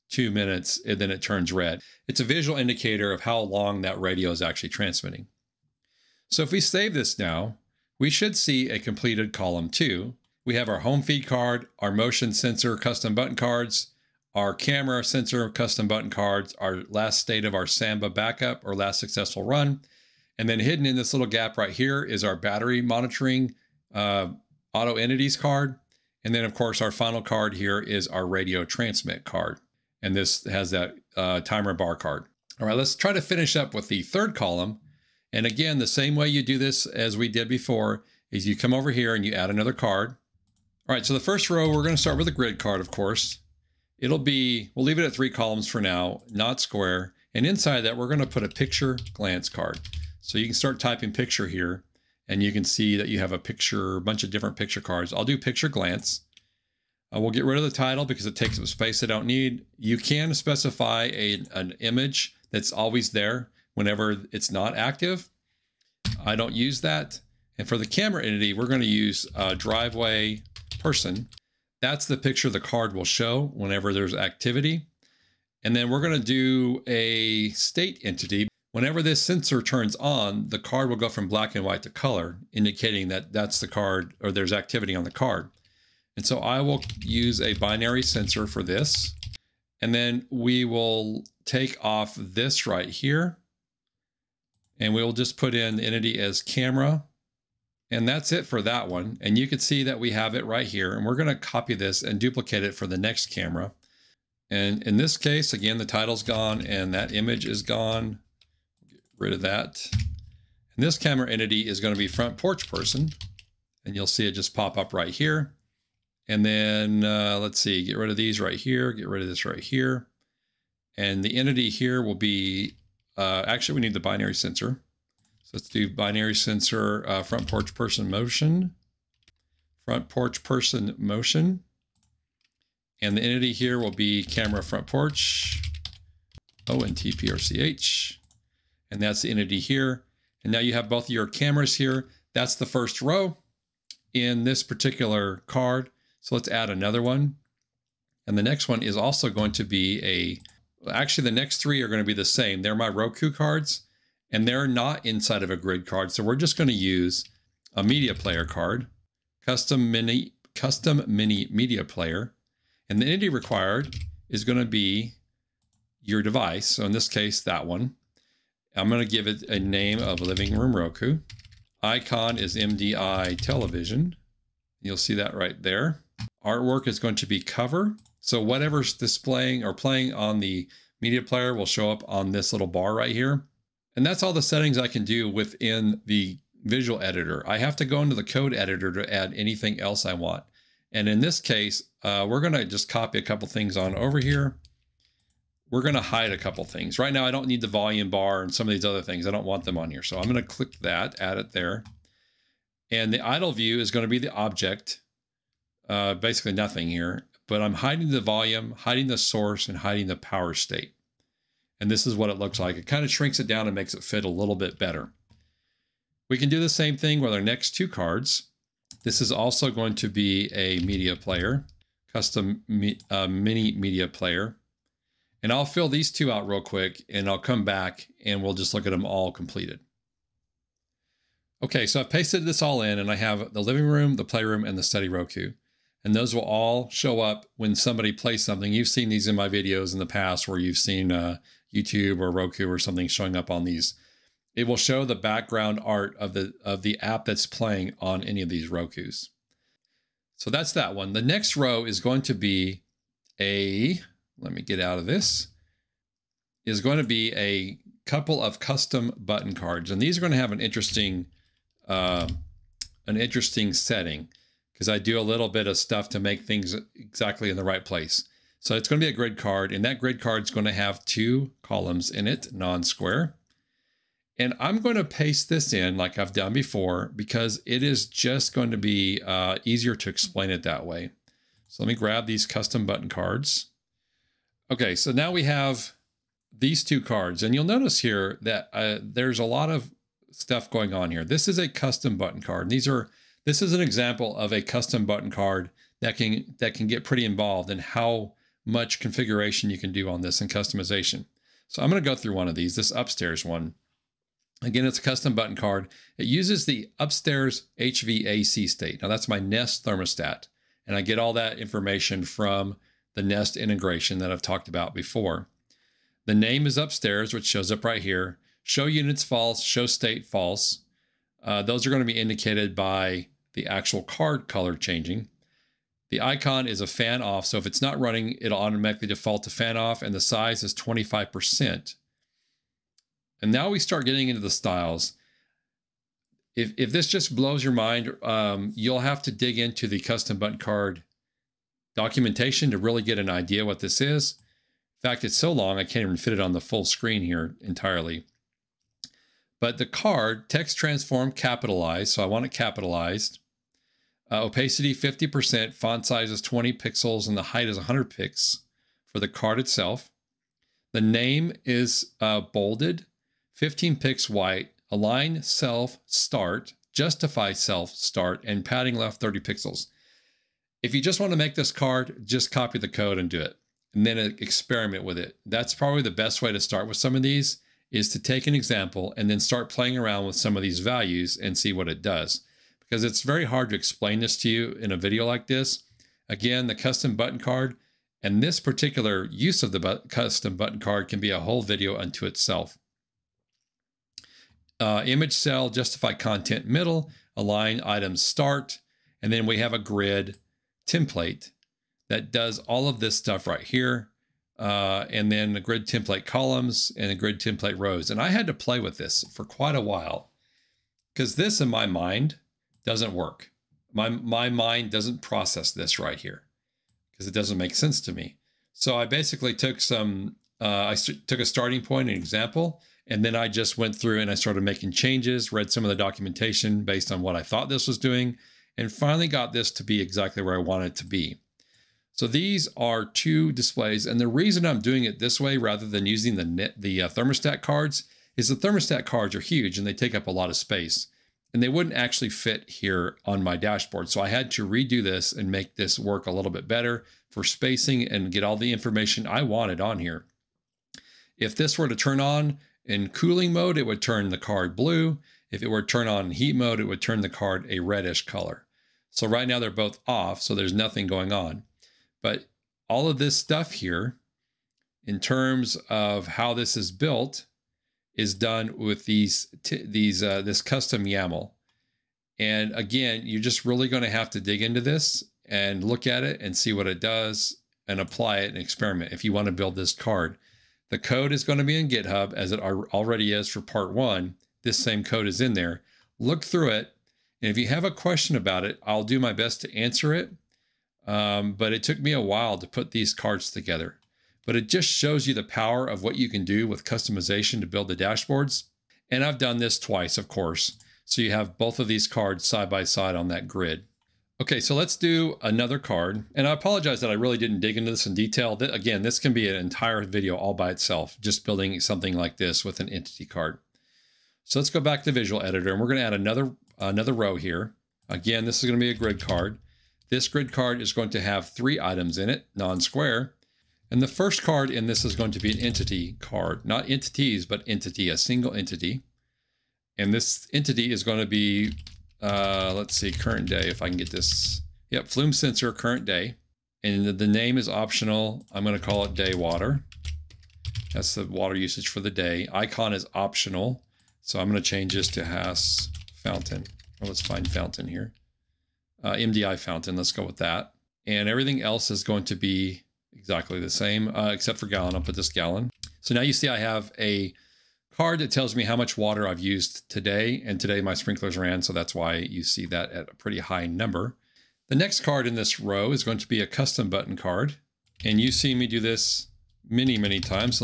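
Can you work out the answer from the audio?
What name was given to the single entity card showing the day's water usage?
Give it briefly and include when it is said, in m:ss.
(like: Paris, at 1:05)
day water, at 8:59.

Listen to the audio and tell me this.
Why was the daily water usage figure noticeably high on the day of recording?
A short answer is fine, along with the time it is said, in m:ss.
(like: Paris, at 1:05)
sprinklers ran, at 9:20.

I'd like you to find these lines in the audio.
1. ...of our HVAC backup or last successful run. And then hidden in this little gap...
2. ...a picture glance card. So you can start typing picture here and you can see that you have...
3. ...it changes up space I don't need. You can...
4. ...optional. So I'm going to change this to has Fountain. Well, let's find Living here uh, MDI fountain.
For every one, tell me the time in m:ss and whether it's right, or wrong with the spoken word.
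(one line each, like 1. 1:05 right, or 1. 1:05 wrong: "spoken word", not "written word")
1. 0:17 wrong: "Samba", not "HVAC"
2. 0:48 right
3. 0:58 wrong: "takes", not "changes"
4. 9:03 wrong: "Fountain", not "Living".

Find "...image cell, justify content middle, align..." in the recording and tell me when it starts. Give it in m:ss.
6:35.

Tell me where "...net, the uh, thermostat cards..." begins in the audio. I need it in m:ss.
7:16.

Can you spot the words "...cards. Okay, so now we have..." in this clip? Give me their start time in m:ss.
4:43.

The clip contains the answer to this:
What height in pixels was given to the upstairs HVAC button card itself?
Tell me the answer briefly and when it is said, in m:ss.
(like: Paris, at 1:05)
100 pixels, at 5:57.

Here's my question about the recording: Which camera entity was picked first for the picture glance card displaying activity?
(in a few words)
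driveway person.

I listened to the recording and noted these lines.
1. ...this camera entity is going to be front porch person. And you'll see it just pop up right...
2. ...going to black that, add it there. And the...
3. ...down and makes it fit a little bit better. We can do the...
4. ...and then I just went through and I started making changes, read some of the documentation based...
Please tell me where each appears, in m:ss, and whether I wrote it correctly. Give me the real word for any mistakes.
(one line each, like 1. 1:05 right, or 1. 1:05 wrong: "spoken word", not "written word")
1. 1:50 right
2. 3:20 wrong: "click", not "black"
3. 3:33 right
4. 7:03 right.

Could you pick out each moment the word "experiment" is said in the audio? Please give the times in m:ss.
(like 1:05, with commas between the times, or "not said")
6:14, 7:58.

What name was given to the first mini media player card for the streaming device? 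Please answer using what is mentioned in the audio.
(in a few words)
Living Room Roku.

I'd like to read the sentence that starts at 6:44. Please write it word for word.
Uh, and then the grid template columns and the grid template rows.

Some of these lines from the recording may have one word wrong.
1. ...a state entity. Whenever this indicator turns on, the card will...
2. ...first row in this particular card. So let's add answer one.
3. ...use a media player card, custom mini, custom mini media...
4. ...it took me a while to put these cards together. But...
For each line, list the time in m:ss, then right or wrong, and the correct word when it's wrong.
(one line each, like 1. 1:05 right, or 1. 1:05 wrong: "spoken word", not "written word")
1. 1:16 wrong: "sensor", not "indicator"
2. 2:22 wrong: "another", not "answer"
3. 2:36 right
4. 8:11 right.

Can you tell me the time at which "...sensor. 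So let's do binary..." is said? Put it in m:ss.
2:04.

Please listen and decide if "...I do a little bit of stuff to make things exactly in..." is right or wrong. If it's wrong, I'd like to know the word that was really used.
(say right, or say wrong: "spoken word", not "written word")
right.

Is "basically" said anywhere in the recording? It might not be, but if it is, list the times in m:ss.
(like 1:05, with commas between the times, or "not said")
3:26, 6:59.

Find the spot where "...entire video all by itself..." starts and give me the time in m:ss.
8:29.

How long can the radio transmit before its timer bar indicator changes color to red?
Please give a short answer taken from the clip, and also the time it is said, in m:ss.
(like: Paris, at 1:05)
2 minutes, at 0:00.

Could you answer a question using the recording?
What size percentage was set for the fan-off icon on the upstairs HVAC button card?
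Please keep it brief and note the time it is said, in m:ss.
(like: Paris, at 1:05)
25%, at 5:30.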